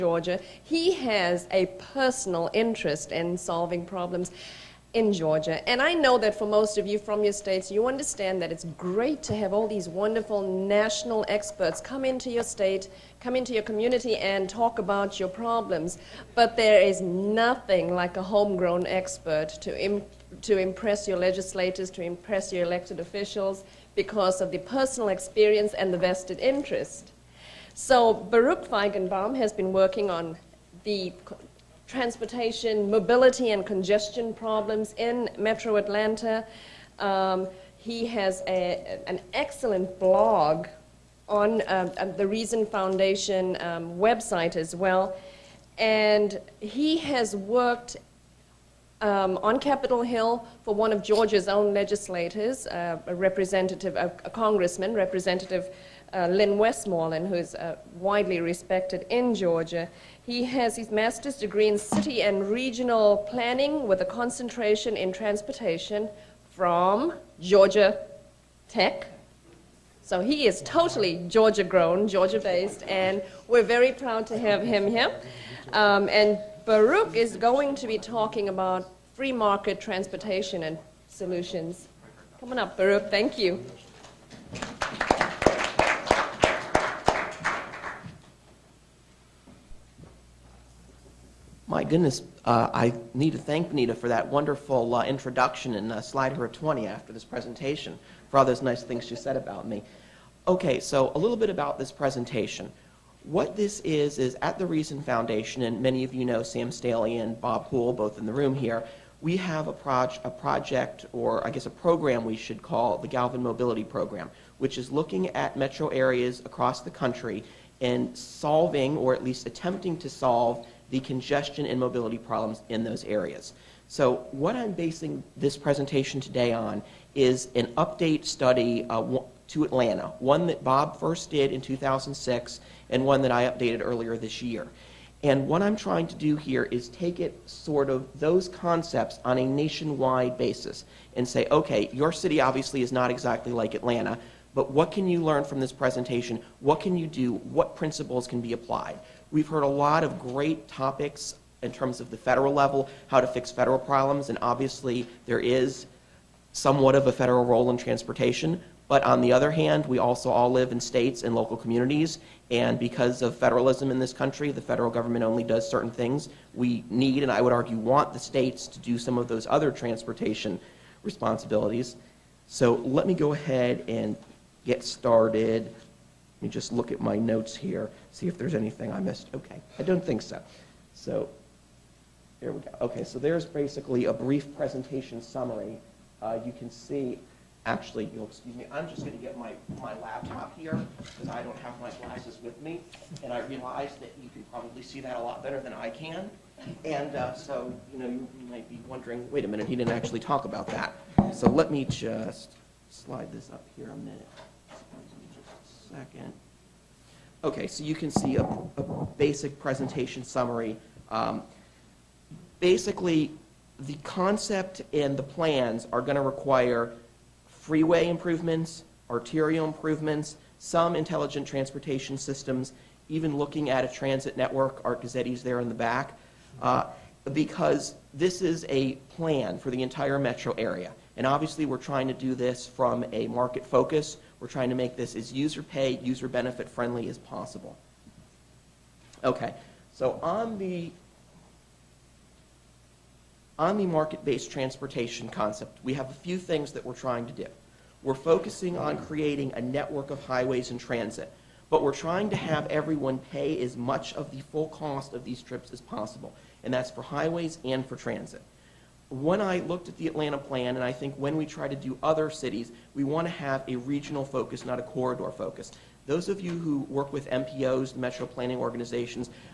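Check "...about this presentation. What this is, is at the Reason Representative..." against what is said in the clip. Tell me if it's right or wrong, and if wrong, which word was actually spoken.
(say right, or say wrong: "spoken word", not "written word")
wrong: "Foundation", not "Representative".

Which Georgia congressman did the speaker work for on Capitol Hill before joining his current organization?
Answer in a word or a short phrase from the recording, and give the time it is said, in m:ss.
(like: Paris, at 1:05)
Lynn Westmoreland, at 0:56.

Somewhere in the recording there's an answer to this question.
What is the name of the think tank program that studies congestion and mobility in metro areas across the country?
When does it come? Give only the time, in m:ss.
1:53.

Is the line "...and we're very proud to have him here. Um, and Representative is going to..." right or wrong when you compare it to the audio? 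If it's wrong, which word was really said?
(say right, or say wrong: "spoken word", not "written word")
wrong: "Baruch", not "Representative".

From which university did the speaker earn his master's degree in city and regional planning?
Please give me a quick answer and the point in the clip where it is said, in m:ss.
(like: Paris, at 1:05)
Georgia Tech, at 1:07.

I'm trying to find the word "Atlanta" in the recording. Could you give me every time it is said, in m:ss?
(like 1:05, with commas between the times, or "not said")
0:35, 2:09, 2:23, 4:20.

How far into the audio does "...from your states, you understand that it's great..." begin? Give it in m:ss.
0:06.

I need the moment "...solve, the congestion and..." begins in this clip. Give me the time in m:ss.
2:00.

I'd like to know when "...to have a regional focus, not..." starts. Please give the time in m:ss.
4:23.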